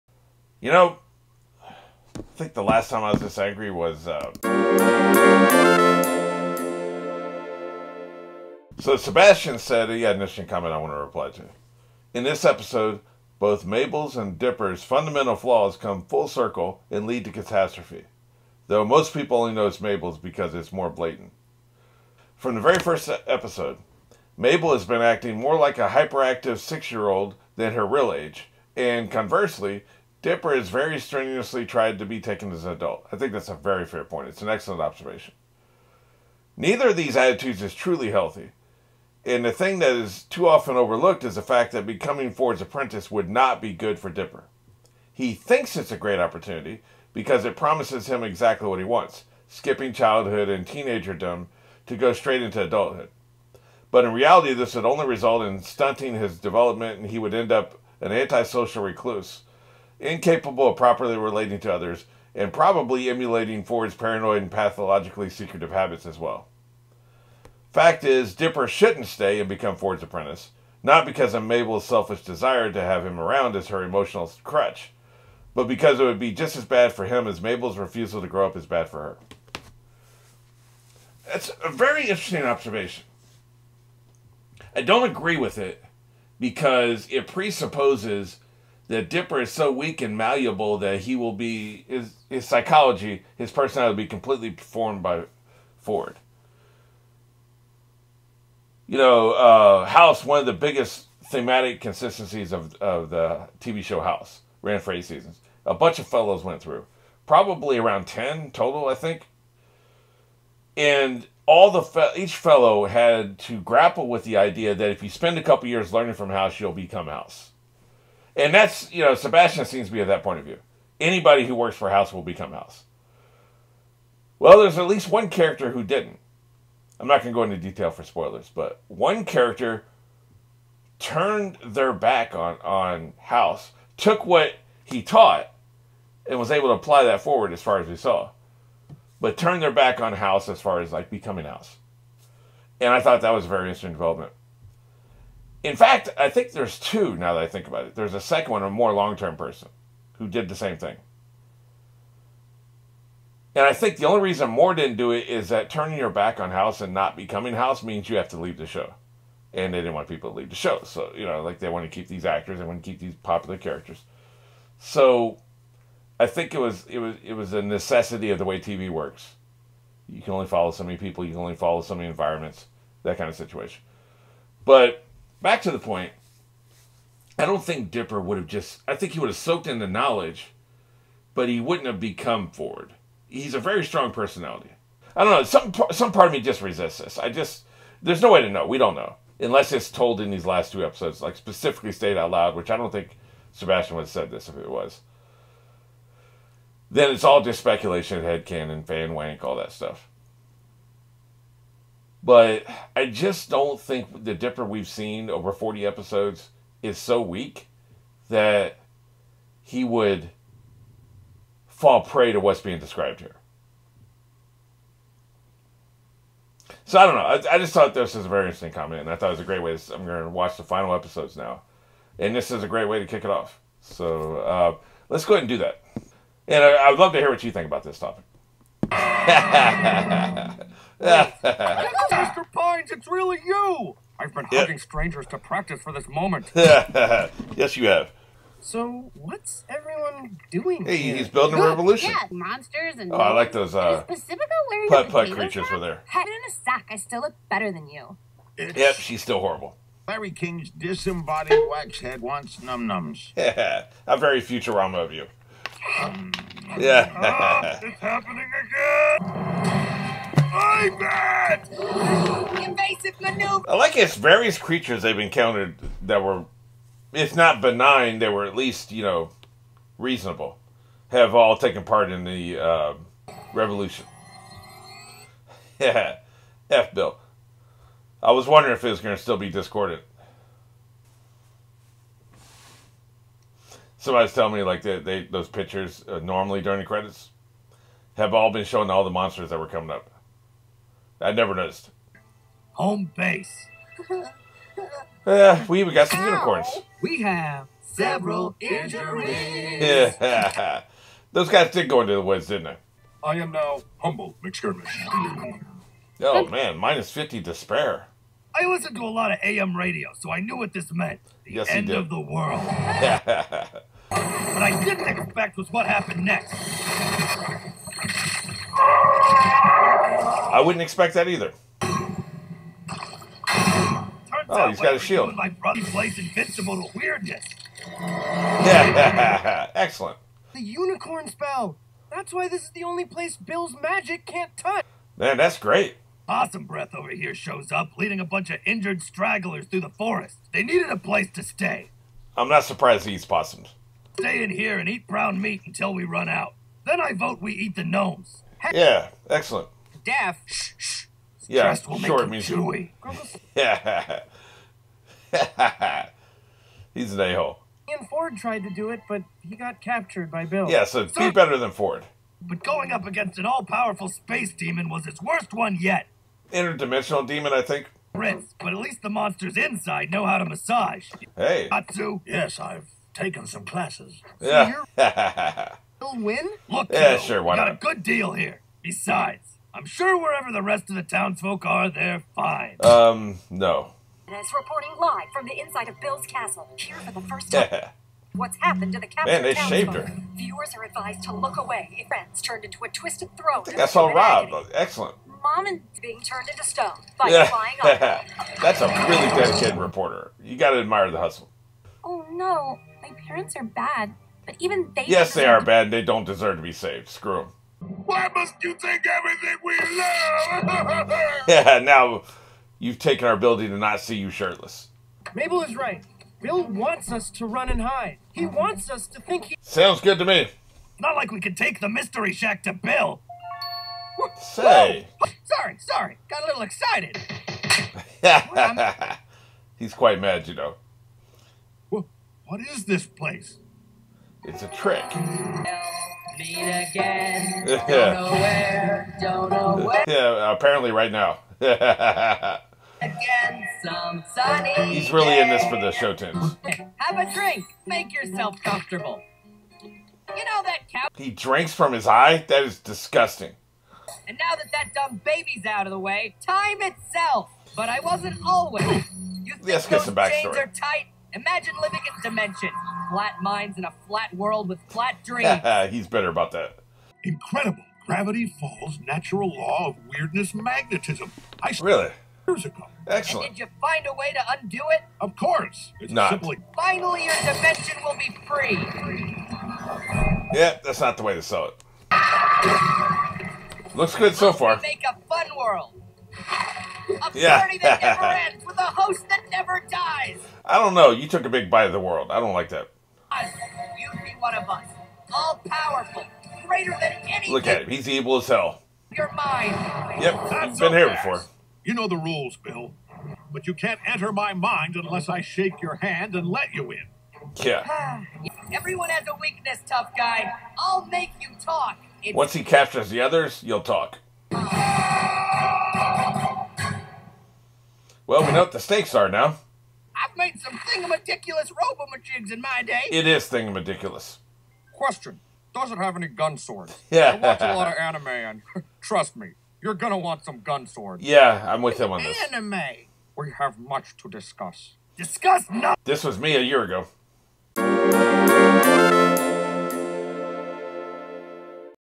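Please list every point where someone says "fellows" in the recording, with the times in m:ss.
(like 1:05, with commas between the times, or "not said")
1:46, 1:52.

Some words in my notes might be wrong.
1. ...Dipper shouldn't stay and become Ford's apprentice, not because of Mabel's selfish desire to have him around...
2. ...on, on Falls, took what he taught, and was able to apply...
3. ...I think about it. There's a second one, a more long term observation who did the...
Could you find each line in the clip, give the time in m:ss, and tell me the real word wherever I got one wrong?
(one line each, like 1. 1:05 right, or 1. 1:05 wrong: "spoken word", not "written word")
1. 1:08 right
2. 2:12 wrong: "House", not "Falls"
3. 2:27 wrong: "person", not "observation".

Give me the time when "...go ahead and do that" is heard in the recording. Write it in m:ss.
3:45.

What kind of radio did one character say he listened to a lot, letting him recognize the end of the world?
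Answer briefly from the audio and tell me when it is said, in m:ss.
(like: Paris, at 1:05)
AM radio, at 5:09.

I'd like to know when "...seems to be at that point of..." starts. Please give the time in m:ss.
1:59.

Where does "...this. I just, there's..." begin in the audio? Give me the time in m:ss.
3:06.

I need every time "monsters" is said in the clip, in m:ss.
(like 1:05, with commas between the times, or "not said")
4:02, 4:49, 6:09.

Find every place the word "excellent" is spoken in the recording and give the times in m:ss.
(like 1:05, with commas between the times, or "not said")
0:34, 5:29, 5:49, 6:34, 7:53.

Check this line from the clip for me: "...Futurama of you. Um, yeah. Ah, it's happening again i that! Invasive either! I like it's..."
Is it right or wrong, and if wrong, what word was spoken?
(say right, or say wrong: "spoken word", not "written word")
wrong: "maneuver", not "either".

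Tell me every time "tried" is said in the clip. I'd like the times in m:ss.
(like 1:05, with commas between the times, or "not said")
0:31, 5:58.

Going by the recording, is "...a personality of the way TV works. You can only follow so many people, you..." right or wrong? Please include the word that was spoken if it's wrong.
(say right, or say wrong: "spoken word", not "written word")
wrong: "necessity", not "personality".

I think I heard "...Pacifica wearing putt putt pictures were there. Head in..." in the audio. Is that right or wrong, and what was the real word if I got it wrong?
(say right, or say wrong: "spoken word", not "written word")
wrong: "creatures", not "pictures".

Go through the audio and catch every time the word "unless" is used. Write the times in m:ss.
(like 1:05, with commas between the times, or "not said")
3:09, 8:24.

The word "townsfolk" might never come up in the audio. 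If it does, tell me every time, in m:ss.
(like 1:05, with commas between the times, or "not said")
6:21, 6:29.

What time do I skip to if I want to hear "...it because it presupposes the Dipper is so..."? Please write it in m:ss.
1:25.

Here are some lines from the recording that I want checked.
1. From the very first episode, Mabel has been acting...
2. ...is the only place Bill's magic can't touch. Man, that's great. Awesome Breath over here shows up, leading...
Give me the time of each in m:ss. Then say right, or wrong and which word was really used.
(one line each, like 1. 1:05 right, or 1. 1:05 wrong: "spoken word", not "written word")
1. 0:22 right
2. 5:32 right.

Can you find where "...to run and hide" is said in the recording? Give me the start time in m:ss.
6:57.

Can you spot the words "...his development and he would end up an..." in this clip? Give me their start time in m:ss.
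0:56.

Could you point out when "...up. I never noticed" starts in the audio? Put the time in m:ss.
4:49.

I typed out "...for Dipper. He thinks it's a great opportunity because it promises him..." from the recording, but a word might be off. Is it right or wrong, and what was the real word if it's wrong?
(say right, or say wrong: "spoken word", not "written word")
right.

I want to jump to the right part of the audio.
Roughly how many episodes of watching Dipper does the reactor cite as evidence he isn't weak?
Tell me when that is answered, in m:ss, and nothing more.
3:25.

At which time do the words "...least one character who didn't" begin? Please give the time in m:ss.
2:04.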